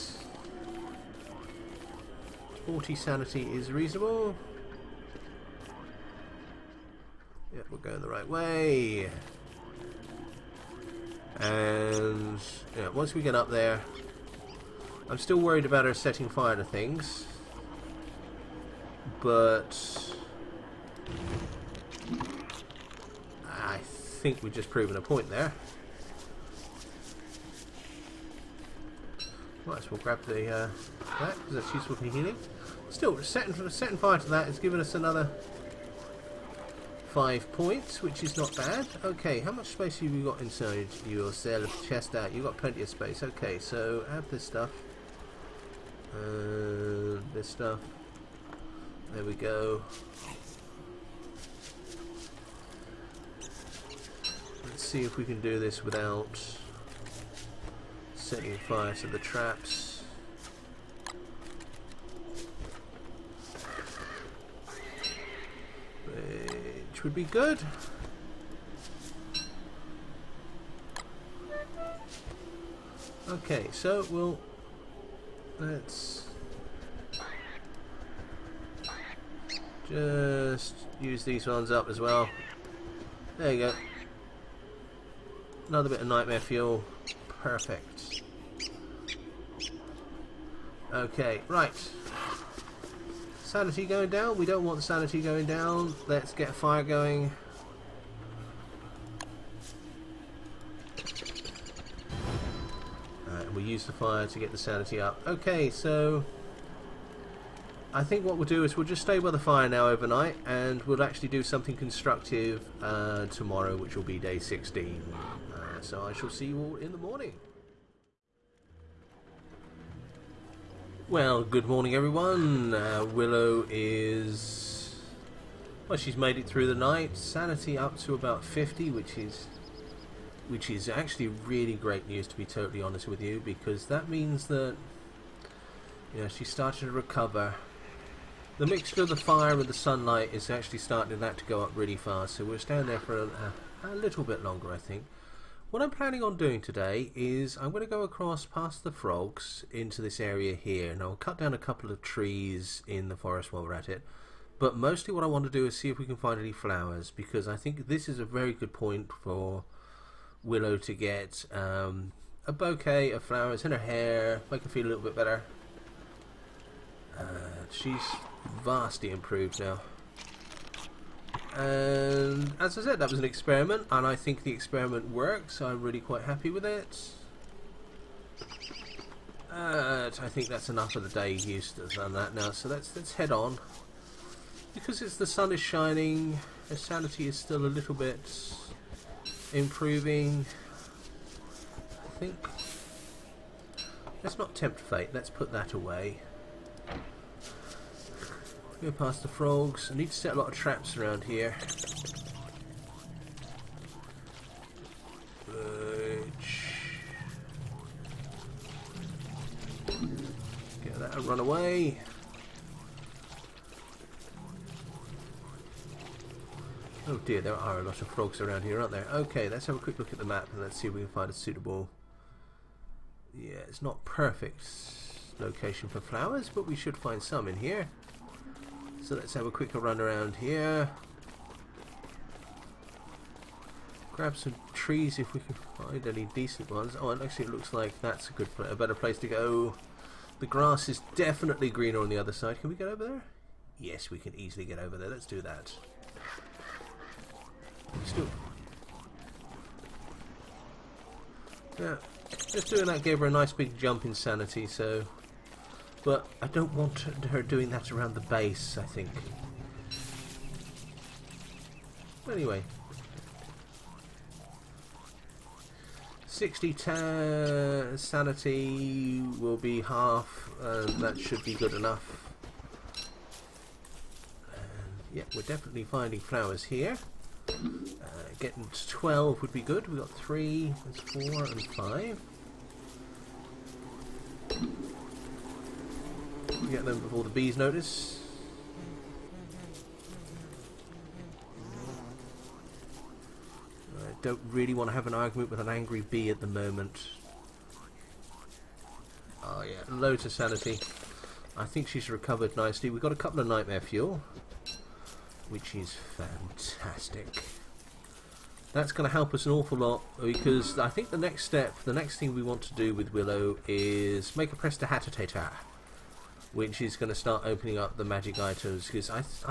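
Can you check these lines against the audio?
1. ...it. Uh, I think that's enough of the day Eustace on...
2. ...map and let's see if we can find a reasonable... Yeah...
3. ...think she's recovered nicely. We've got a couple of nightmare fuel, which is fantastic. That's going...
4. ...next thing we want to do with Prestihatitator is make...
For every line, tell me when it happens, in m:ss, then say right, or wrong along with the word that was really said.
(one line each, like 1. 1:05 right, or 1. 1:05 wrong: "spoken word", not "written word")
1. 2:56 right
2. 3:40 wrong: "suitable", not "reasonable"
3. 5:01 right
4. 5:11 wrong: "Willow", not "Prestihatitator".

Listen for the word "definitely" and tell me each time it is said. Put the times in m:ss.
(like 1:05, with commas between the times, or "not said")
4:01, 4:35.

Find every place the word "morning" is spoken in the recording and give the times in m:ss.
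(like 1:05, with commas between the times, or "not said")
1:56, 2:01.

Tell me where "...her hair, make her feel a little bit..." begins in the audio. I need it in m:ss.
2:43.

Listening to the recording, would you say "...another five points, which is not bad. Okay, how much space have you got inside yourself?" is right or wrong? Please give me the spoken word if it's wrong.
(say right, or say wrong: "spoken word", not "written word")
right.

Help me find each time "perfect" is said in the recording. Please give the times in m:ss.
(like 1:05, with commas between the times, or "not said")
1:27, 3:44.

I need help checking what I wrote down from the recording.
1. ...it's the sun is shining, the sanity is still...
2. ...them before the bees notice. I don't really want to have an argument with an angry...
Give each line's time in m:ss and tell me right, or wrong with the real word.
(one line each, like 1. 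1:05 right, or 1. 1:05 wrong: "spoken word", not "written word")
1. 3:05 right
2. 4:46 right.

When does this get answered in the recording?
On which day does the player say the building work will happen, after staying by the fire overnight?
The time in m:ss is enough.
1:54.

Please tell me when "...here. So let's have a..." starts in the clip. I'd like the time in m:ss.
3:47.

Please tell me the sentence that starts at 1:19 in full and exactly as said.
Just use these ones up as well.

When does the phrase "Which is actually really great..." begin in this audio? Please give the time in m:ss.
2:10.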